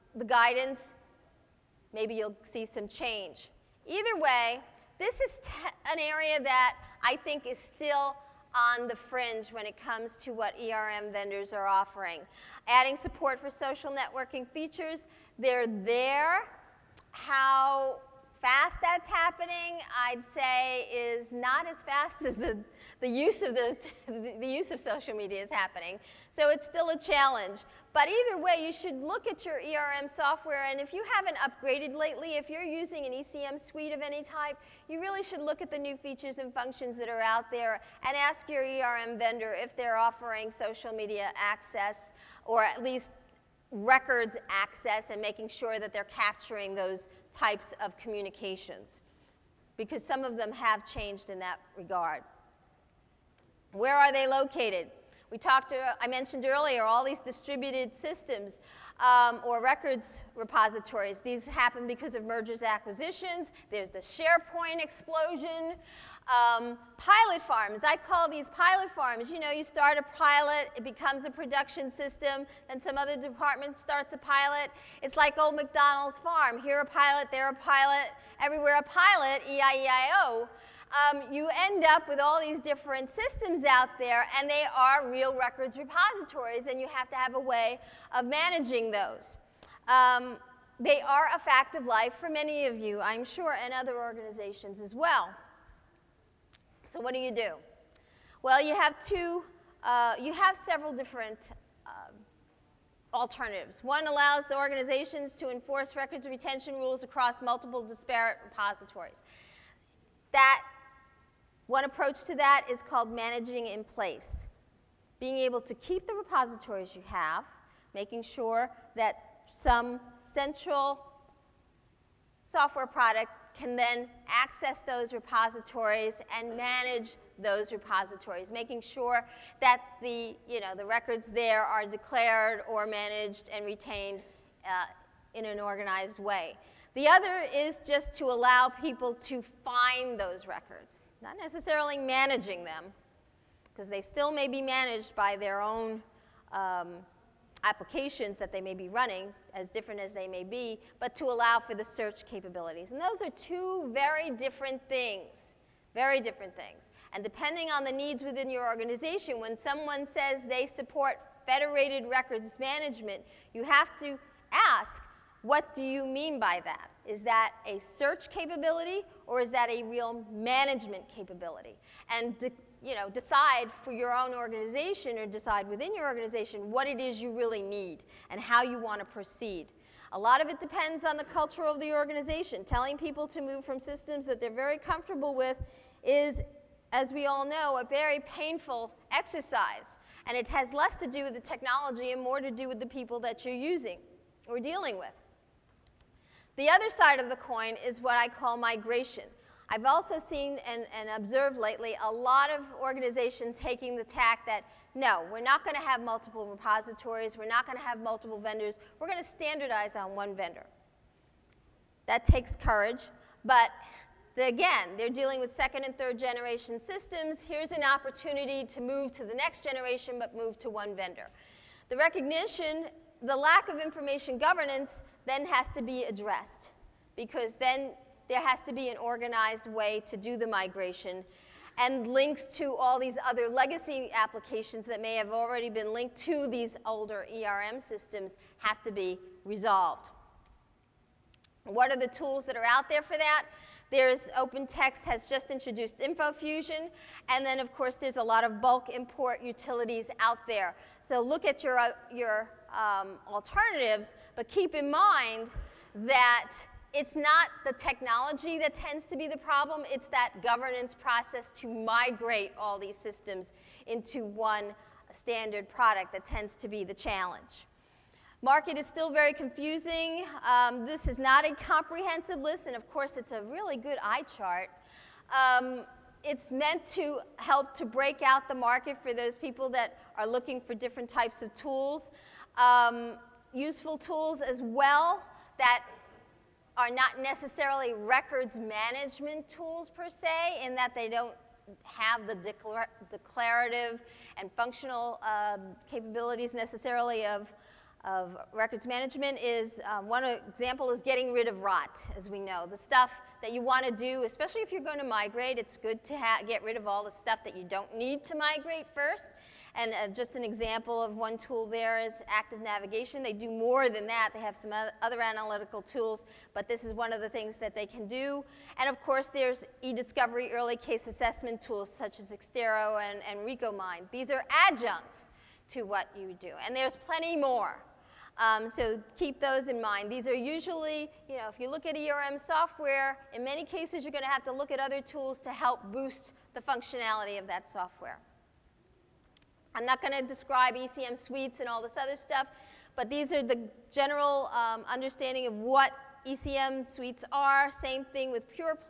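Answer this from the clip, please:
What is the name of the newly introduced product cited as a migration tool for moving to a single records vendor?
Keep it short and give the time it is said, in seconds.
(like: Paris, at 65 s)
InfoFusion, at 245 s.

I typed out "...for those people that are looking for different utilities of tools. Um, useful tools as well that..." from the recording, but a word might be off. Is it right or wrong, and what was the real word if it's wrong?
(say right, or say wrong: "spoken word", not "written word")
wrong: "types", not "utilities".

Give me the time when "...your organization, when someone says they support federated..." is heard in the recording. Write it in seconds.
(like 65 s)
158 s.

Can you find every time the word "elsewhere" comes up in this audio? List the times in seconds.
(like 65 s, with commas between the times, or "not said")
not said.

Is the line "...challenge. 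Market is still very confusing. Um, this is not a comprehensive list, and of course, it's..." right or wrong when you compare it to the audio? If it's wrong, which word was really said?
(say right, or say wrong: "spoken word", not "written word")
right.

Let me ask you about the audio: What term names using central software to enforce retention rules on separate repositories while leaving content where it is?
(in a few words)
Managing in place.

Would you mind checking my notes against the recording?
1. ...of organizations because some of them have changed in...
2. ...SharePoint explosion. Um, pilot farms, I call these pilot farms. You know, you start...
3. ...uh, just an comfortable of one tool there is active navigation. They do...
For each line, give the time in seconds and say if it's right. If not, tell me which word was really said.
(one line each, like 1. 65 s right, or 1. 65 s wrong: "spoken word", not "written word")
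1. 47 s wrong: "communications", not "organizations"
2. 63 s right
3. 309 s wrong: "example", not "comfortable".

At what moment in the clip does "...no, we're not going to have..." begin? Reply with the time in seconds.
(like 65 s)
204 s.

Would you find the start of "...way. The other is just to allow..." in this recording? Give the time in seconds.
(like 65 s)
136 s.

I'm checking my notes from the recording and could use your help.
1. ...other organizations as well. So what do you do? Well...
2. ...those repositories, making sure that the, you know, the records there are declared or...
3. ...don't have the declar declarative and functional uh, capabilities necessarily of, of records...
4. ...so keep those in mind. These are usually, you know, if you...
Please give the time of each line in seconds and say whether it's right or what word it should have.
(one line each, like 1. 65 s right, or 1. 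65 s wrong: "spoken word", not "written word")
1. 93 s right
2. 127 s right
3. 291 s right
4. 328 s right.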